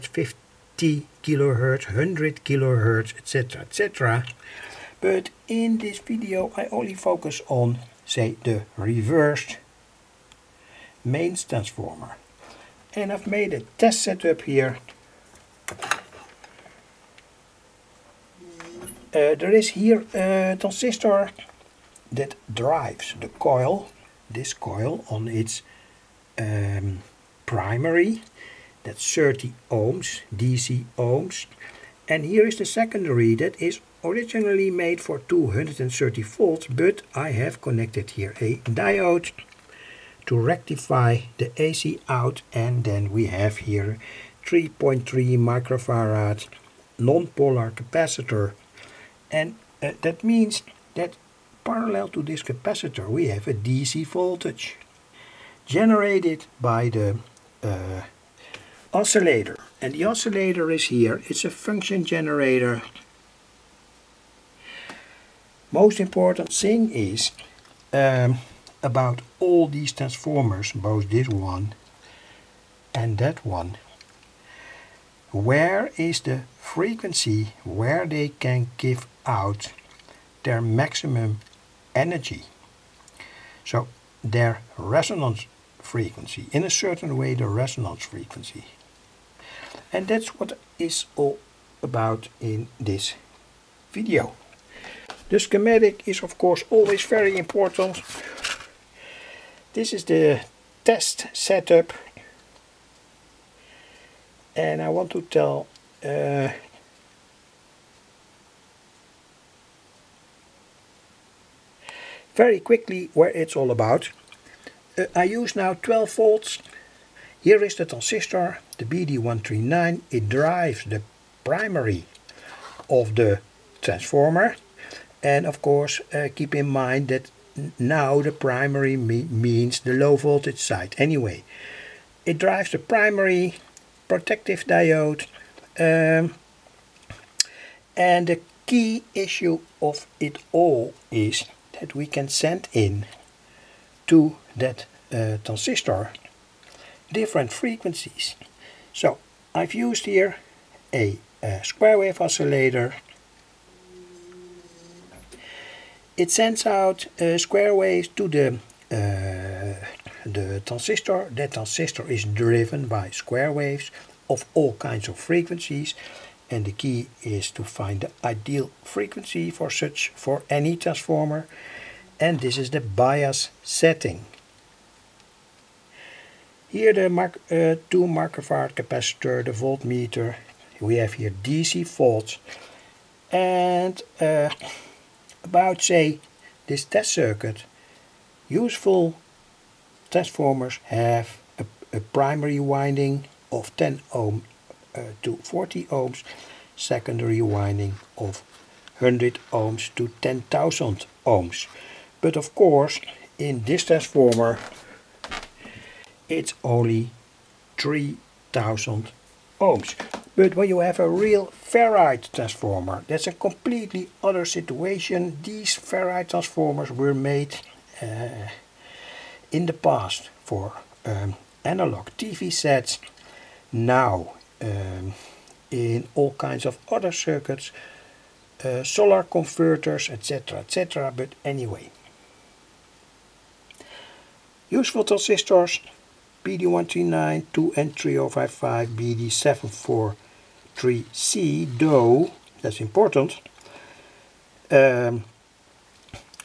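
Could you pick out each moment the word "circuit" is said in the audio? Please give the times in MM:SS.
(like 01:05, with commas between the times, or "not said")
03:07, 03:47.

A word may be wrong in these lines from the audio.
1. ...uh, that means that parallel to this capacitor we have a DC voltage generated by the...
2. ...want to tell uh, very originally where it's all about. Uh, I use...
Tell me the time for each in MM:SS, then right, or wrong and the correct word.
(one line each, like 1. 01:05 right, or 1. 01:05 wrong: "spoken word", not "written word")
1. 00:49 right
2. 01:44 wrong: "quickly", not "originally".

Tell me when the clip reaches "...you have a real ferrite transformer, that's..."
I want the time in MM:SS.
03:30.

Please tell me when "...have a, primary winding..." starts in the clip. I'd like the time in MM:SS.
03:10.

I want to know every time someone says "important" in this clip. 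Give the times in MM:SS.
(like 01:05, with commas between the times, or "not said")
01:06, 01:37, 04:02.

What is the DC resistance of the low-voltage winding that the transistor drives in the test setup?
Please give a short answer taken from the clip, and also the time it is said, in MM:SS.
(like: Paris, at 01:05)
30 ohms, at 00:29.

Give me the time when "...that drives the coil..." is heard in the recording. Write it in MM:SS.
00:22.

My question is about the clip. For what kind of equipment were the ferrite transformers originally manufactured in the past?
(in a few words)
analog TV sets.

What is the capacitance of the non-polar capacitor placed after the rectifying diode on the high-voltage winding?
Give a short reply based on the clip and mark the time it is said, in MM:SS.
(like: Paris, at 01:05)
3.3 microfarad, at 00:44.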